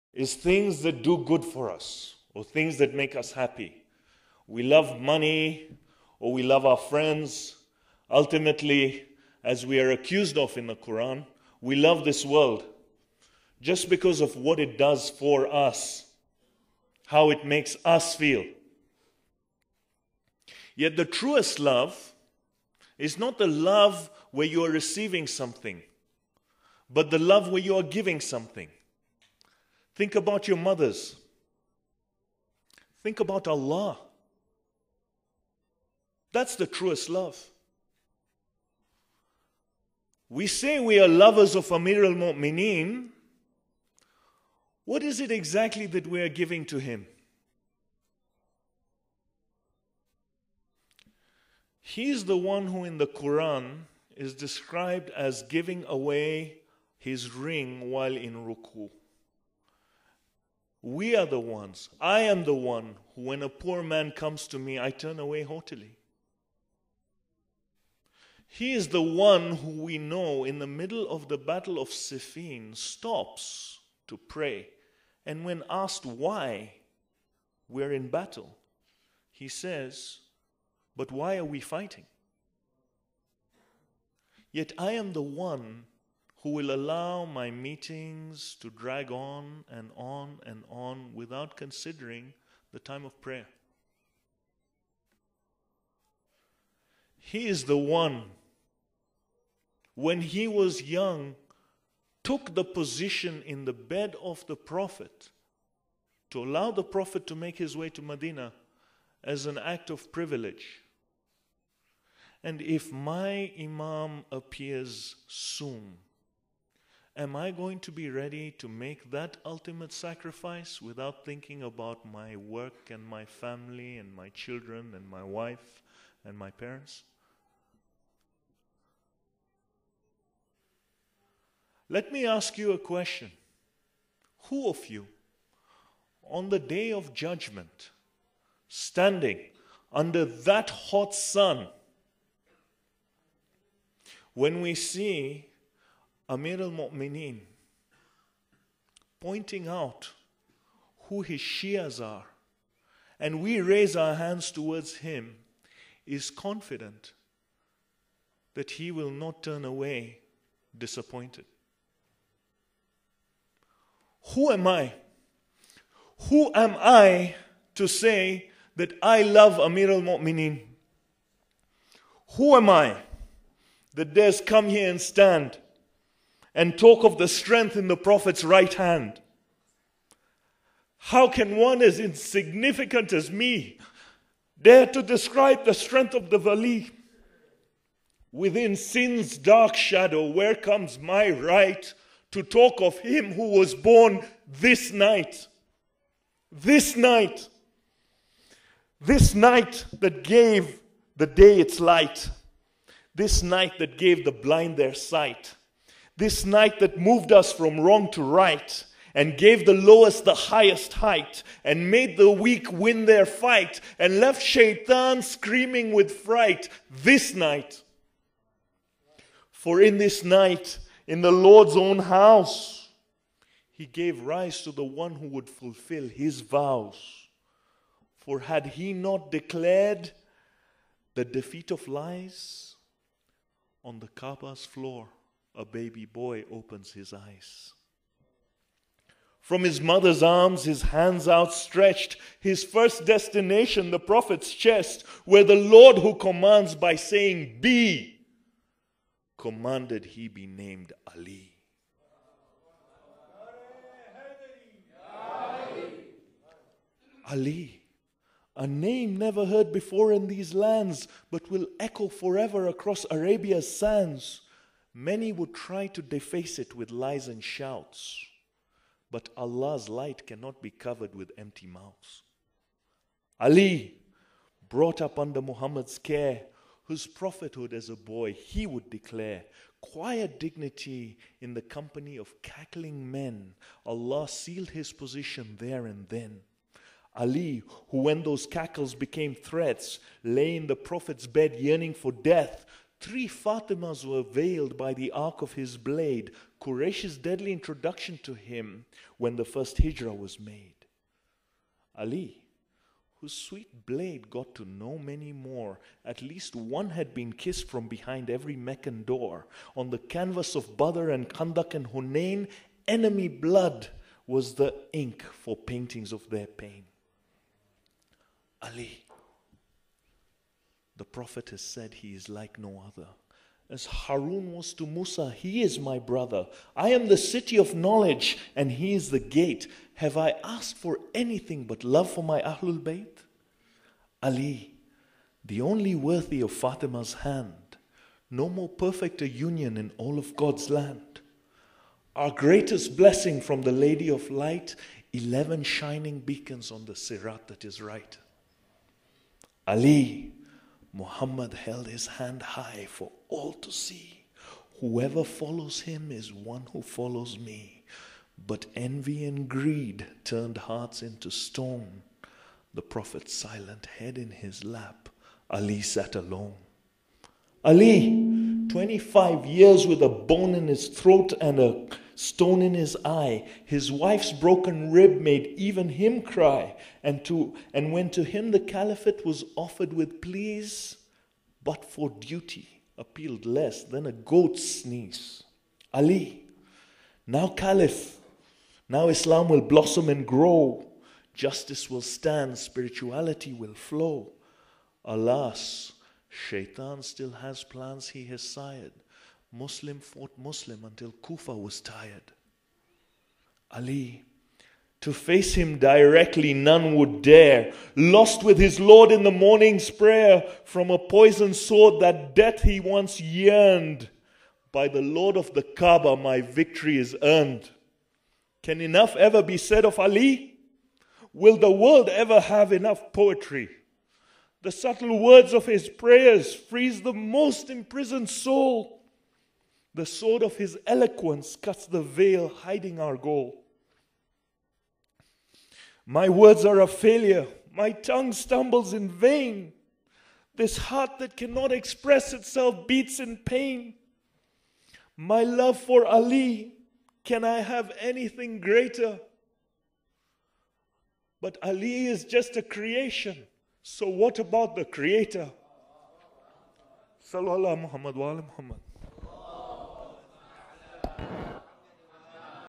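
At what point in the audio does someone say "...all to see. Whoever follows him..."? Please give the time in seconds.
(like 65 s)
353 s.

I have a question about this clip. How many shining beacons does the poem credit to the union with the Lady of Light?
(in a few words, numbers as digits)
11.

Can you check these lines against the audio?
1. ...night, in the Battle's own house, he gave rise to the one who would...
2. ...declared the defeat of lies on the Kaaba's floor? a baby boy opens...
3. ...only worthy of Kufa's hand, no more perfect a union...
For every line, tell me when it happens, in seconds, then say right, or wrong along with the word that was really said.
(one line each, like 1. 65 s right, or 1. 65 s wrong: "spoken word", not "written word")
1. 220 s wrong: "Lord", not "Battle"
2. 229 s right
3. 335 s wrong: "Fatima", not "Kufa".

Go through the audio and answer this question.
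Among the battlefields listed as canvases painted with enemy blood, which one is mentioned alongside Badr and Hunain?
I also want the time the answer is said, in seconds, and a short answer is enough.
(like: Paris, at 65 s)
Khandak, at 311 s.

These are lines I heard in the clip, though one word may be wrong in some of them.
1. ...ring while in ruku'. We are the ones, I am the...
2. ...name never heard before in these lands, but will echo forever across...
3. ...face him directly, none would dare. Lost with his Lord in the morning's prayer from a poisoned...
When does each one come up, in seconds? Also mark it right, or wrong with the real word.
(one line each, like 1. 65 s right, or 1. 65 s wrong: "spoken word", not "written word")
1. 57 s right
2. 258 s right
3. 405 s right.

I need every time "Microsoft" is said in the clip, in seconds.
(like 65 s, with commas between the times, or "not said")
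not said.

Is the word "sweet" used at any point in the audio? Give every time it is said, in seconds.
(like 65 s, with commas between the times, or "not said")
303 s.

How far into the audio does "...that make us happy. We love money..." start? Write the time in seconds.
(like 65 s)
2 s.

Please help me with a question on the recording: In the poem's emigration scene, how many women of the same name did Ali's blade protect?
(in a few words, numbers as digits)
3.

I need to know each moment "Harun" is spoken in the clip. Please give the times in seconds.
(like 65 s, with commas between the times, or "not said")
323 s.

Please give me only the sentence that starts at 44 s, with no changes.
What is it exactly that we are giving to him?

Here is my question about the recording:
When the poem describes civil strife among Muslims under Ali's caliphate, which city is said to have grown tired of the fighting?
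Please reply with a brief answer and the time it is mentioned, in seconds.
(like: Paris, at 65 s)
Kufa, at 401 s.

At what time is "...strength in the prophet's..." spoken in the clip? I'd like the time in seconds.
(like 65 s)
177 s.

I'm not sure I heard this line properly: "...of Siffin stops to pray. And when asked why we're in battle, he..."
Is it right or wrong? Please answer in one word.
right.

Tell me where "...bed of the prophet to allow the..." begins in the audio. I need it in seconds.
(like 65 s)
103 s.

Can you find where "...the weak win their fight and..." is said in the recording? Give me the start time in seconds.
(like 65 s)
212 s.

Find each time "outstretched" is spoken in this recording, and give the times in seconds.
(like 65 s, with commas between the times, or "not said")
241 s.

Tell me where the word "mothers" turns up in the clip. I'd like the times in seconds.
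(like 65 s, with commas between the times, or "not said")
30 s, 239 s.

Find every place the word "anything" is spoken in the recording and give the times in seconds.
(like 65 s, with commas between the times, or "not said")
331 s, 447 s.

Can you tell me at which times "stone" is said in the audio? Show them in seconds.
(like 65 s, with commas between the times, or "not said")
361 s, 372 s.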